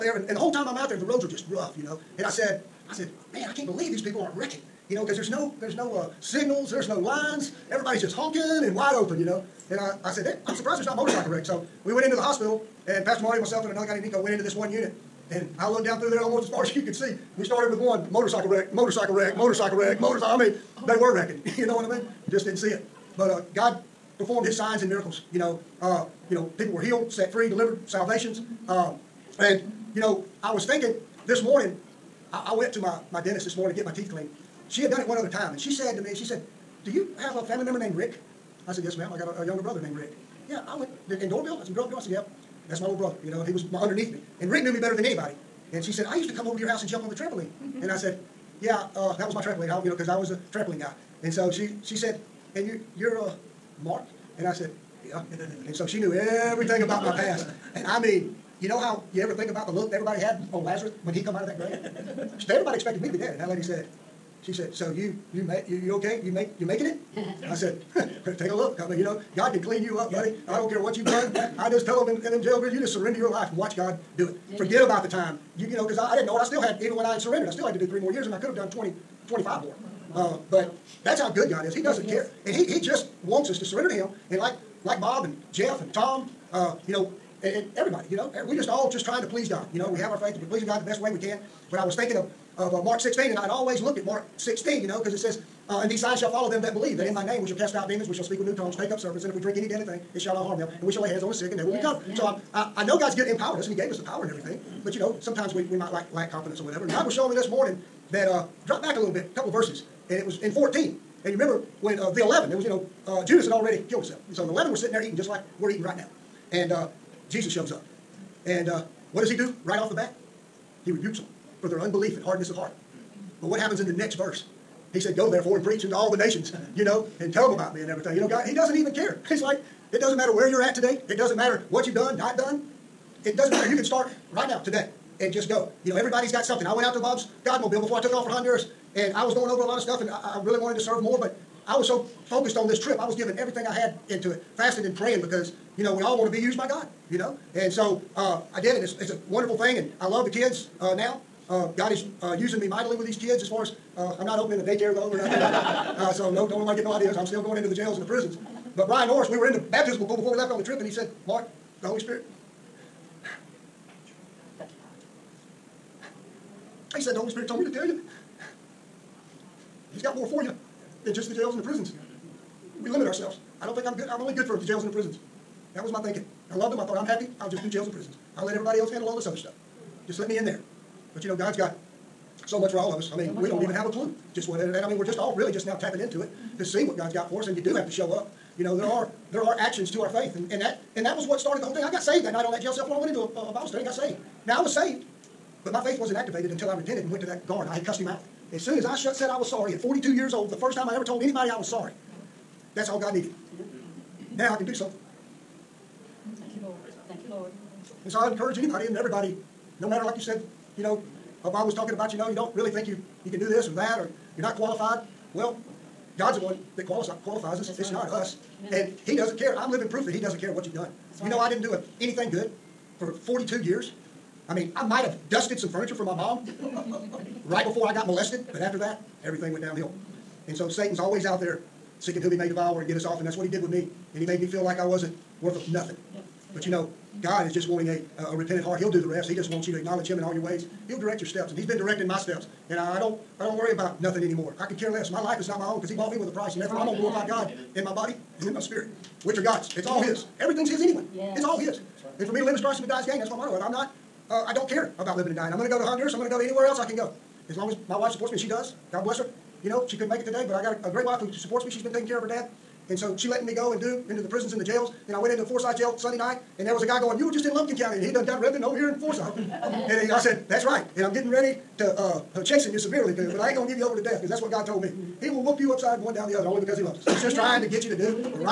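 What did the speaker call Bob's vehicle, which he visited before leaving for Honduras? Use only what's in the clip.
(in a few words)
Godmobile.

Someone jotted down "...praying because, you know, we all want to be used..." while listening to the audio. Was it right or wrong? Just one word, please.
right.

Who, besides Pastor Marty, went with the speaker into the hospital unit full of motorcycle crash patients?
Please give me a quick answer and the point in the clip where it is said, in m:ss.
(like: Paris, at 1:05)
Nico, at 0:14.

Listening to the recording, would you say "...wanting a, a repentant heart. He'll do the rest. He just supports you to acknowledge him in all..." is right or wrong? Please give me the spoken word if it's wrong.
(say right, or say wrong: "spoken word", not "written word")
wrong: "wants", not "supports".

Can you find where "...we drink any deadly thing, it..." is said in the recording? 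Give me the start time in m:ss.
1:39.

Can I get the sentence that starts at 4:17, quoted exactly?
As long as my wife supports me, and she does, God bless her.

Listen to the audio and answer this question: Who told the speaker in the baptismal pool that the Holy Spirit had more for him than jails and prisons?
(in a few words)
Brian Norris.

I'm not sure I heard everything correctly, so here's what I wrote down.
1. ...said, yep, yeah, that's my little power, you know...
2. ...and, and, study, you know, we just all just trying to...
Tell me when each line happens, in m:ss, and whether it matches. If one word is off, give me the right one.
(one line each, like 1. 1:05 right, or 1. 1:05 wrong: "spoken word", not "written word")
1. 0:41 wrong: "brother", not "power"
2. 1:27 wrong: "everybody", not "study".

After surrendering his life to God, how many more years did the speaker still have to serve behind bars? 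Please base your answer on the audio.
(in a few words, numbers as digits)
3.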